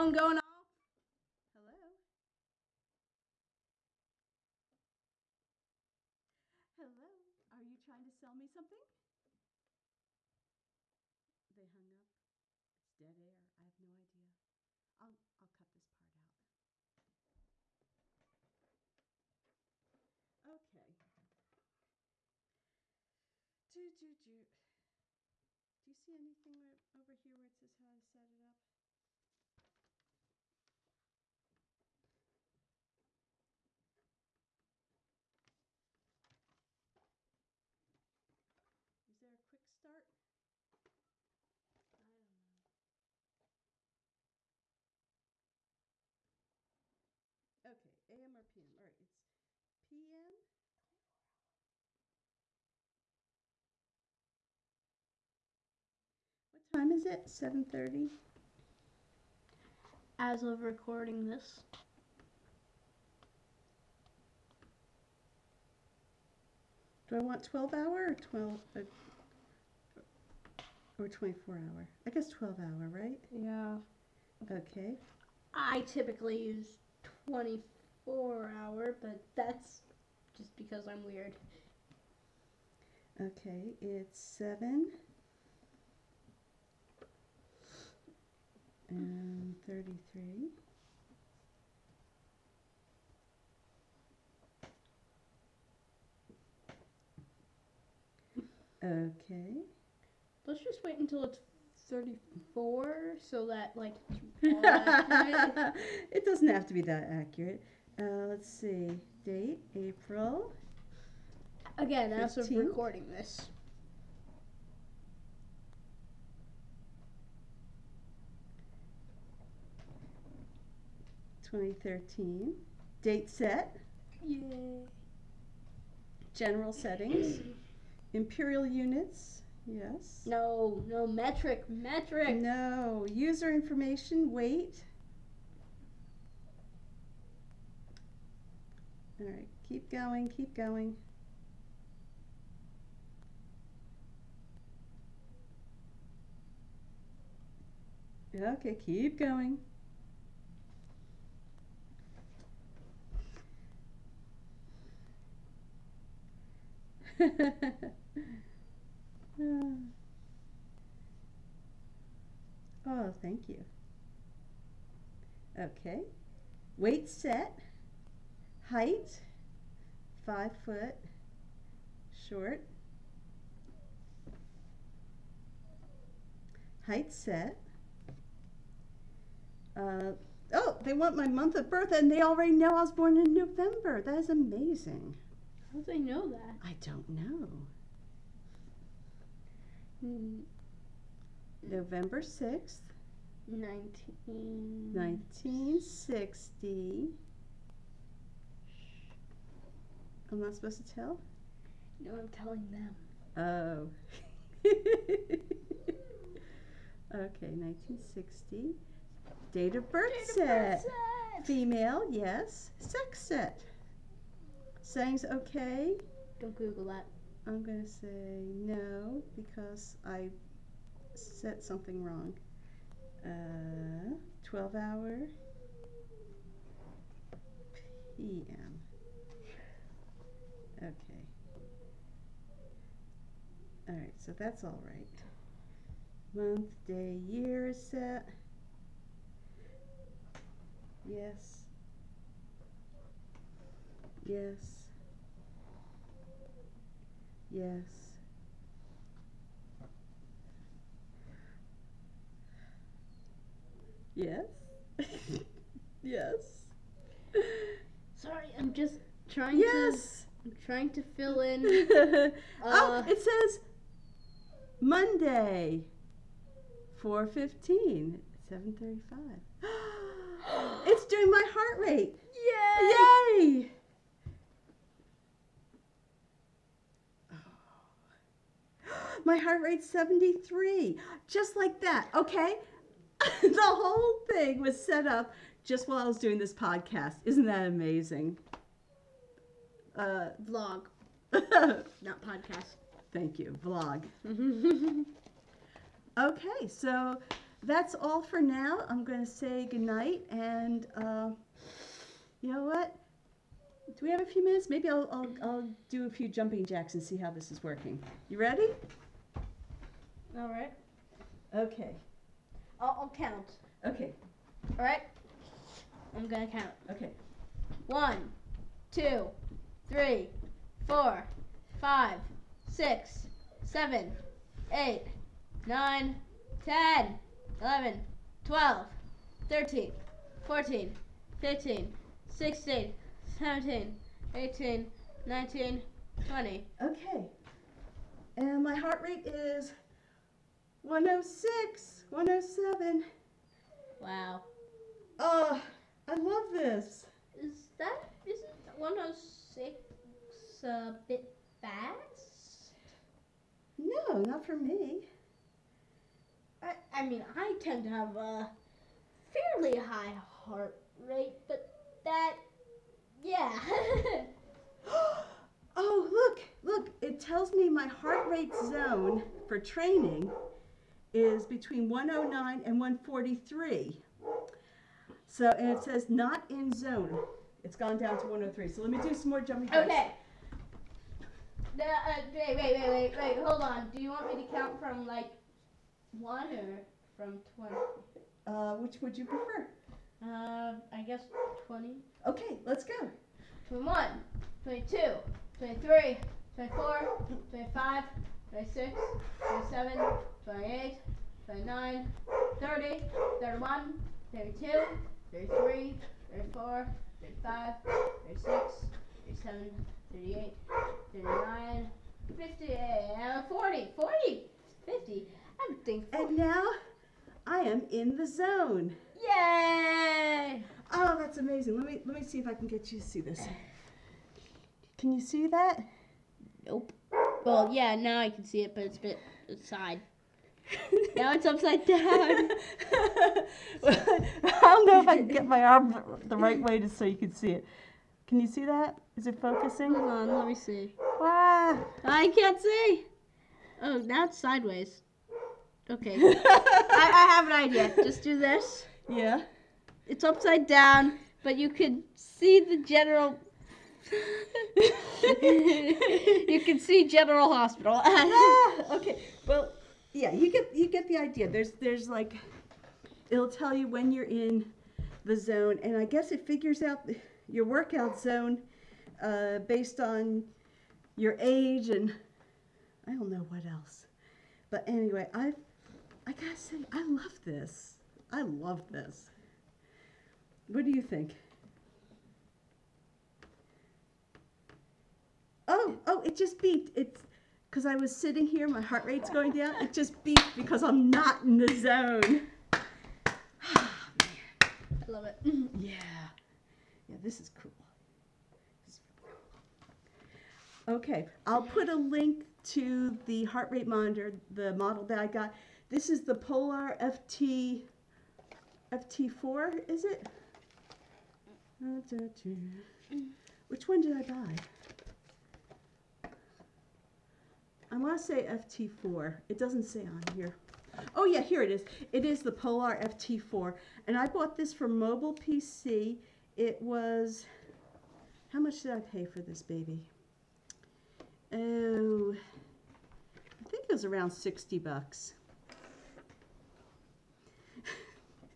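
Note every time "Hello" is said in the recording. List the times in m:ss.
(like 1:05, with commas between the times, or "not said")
0:01, 0:06.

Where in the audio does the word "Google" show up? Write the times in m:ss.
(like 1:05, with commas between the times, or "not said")
3:36.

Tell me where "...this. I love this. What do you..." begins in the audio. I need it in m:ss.
7:57.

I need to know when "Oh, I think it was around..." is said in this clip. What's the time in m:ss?
8:51.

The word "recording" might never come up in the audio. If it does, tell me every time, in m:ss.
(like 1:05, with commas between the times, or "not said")
1:00, 1:52.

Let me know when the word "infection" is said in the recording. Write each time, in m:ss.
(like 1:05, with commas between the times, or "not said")
not said.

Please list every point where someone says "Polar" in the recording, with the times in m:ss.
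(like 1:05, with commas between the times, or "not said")
8:26, 8:42.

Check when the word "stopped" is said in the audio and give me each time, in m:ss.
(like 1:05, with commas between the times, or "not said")
not said.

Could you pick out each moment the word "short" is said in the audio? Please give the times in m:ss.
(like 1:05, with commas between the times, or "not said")
2:52.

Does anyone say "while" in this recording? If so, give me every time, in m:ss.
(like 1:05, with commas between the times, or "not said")
4:45.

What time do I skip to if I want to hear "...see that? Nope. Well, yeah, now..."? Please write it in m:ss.
7:05.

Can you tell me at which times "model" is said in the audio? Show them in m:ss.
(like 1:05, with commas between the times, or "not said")
8:24.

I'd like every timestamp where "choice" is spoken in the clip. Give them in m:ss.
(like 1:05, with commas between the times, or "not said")
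not said.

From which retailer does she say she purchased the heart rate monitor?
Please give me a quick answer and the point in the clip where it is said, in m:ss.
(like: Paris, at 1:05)
Mobile PC, at 8:44.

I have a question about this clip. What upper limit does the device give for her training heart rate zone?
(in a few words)
143.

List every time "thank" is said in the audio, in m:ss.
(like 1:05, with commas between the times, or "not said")
2:43, 4:53.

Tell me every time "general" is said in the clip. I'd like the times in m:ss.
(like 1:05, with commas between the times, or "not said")
2:06, 7:32, 7:37.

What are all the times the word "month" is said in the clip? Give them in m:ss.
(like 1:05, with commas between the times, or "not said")
3:01, 3:56.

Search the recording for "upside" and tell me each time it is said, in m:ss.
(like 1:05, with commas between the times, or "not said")
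7:11, 7:30.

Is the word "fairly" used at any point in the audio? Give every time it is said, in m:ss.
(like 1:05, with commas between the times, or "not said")
5:59.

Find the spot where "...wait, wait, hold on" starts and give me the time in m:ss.
6:22.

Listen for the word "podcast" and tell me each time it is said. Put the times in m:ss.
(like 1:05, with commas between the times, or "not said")
4:46, 4:52.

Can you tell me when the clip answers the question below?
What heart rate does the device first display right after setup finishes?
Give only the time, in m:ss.
4:39.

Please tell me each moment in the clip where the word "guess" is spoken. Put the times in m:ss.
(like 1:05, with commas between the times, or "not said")
1:12, 6:31, 7:46.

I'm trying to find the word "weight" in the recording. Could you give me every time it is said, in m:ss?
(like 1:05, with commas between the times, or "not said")
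2:14, 2:46.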